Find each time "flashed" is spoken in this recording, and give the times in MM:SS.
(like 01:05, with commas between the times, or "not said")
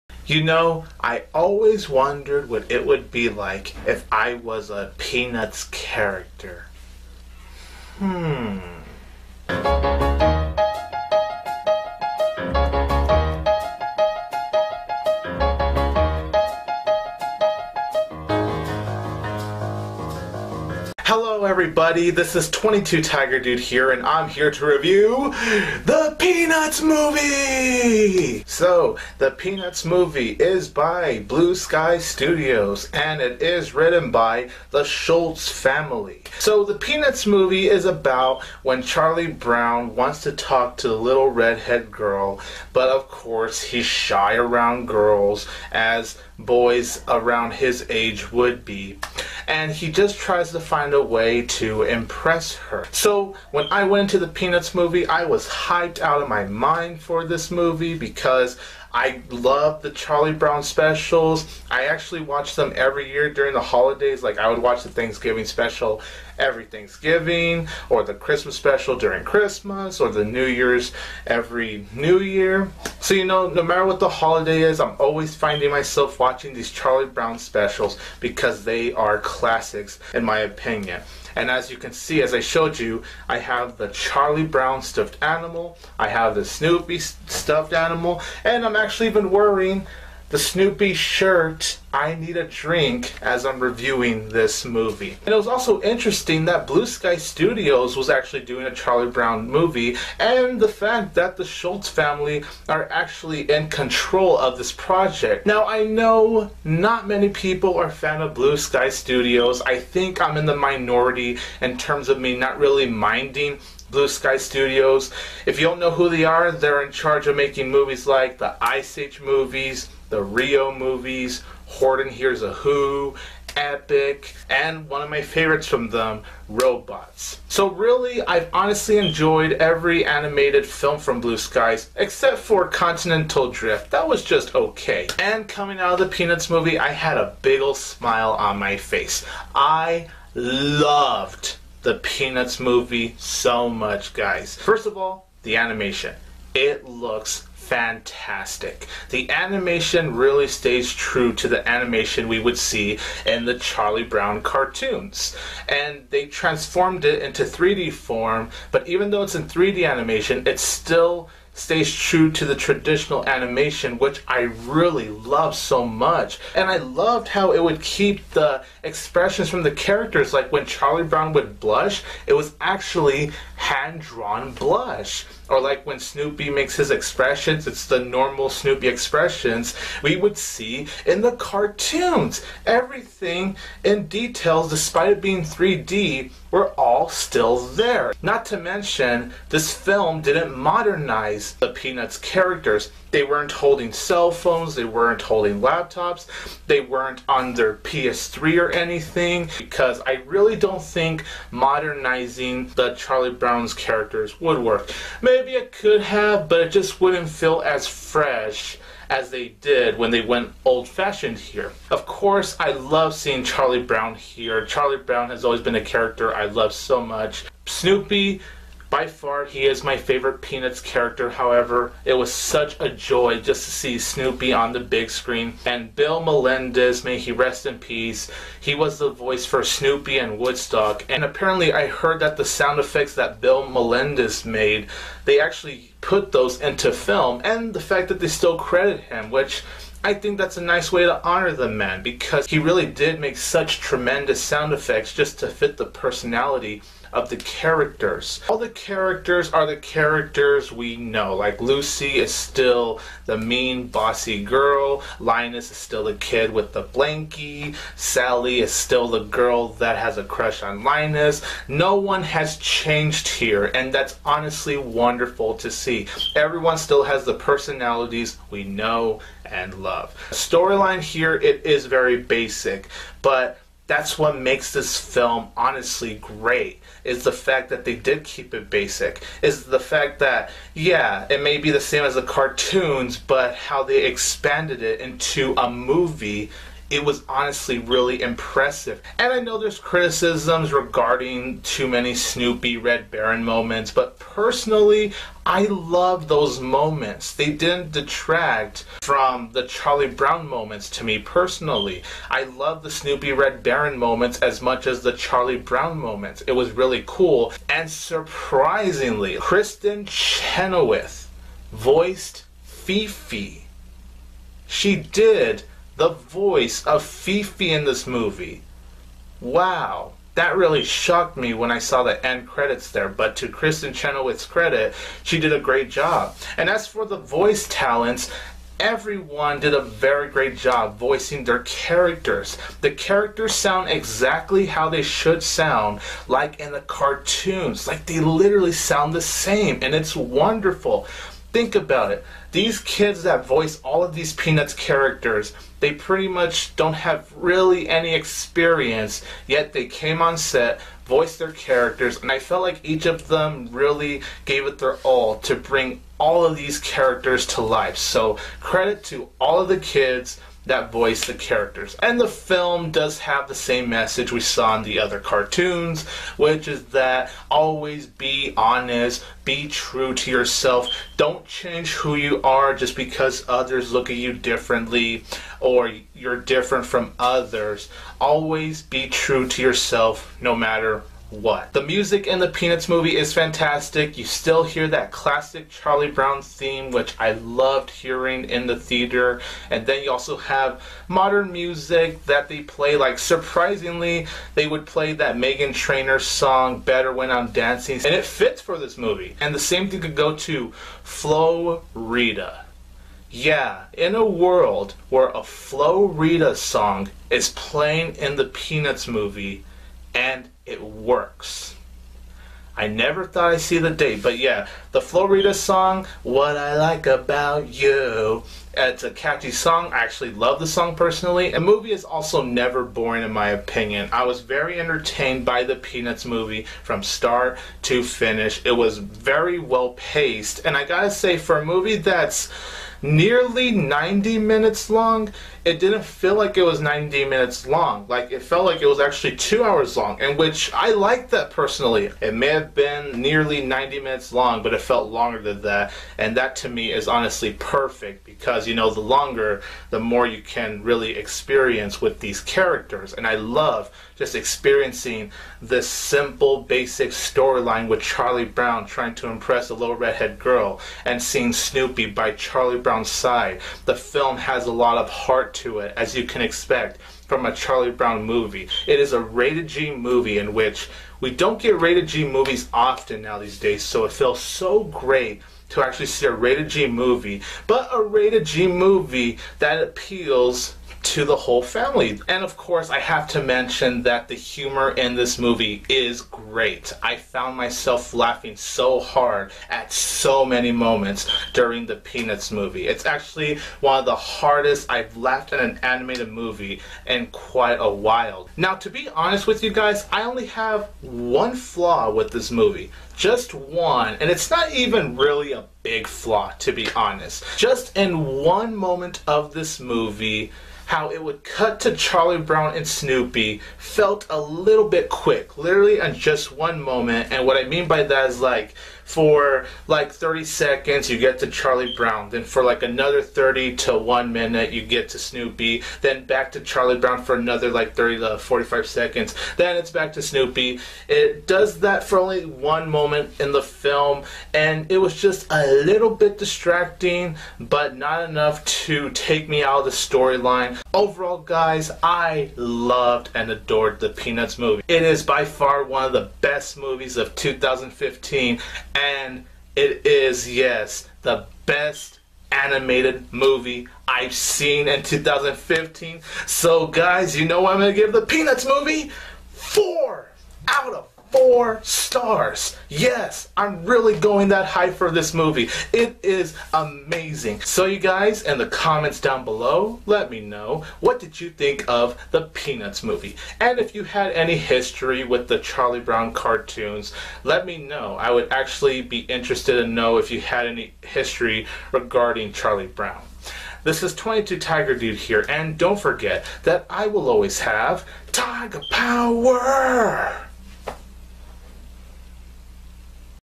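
not said.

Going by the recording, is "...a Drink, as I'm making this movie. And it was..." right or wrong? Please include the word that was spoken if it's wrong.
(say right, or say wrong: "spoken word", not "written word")
wrong: "reviewing", not "making".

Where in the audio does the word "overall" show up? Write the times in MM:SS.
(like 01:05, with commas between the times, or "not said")
09:00.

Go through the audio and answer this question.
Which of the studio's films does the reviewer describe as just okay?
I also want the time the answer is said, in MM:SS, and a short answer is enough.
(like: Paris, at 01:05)
Continental Drift, at 02:12.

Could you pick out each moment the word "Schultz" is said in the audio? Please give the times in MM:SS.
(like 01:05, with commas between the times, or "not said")
00:34, 01:41.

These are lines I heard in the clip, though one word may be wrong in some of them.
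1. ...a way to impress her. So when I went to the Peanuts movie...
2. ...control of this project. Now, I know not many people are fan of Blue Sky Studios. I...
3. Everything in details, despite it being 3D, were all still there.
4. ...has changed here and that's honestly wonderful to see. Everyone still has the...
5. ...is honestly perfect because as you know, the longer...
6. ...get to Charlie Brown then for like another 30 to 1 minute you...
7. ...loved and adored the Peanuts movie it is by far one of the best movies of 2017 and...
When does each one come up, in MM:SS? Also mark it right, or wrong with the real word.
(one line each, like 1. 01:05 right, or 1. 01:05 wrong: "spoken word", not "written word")
1. 00:50 right
2. 01:43 right
3. 03:02 right
4. 04:22 right
5. 07:26 right
6. 08:41 right
7. 09:02 wrong: "2015", not "2017".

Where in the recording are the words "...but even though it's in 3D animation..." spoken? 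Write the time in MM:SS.
02:38.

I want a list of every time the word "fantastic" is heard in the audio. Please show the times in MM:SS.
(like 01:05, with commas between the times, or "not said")
02:27, 06:23.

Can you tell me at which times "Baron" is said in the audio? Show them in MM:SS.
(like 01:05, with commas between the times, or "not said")
04:53, 05:03.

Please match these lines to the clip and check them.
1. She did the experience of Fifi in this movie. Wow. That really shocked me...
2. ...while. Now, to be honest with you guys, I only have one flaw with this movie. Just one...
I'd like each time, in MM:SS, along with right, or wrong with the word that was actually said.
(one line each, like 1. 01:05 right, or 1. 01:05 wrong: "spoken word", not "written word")
1. 05:14 wrong: "voice", not "experience"
2. 08:17 right.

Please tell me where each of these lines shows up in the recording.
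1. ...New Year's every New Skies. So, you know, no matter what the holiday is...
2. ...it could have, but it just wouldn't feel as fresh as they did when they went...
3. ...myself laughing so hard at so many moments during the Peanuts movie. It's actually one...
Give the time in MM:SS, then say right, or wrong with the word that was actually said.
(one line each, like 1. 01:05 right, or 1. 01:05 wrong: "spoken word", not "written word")
1. 01:10 wrong: "Year", not "Skies"
2. 03:25 right
3. 08:07 right.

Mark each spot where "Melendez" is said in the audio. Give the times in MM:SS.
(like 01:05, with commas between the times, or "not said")
03:46, 03:53.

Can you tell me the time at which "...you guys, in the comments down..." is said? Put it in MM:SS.
09:27.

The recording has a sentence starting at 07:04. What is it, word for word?
I was very entertained by the Peanuts movie from start to finish.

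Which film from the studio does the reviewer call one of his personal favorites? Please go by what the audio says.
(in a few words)
Robots.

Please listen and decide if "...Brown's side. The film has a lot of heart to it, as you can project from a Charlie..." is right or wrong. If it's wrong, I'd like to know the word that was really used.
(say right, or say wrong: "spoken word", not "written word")
wrong: "expect", not "project".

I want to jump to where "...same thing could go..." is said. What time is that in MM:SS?
06:39.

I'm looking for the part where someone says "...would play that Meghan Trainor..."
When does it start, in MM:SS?
06:34.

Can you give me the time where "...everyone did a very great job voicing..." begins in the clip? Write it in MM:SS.
05:28.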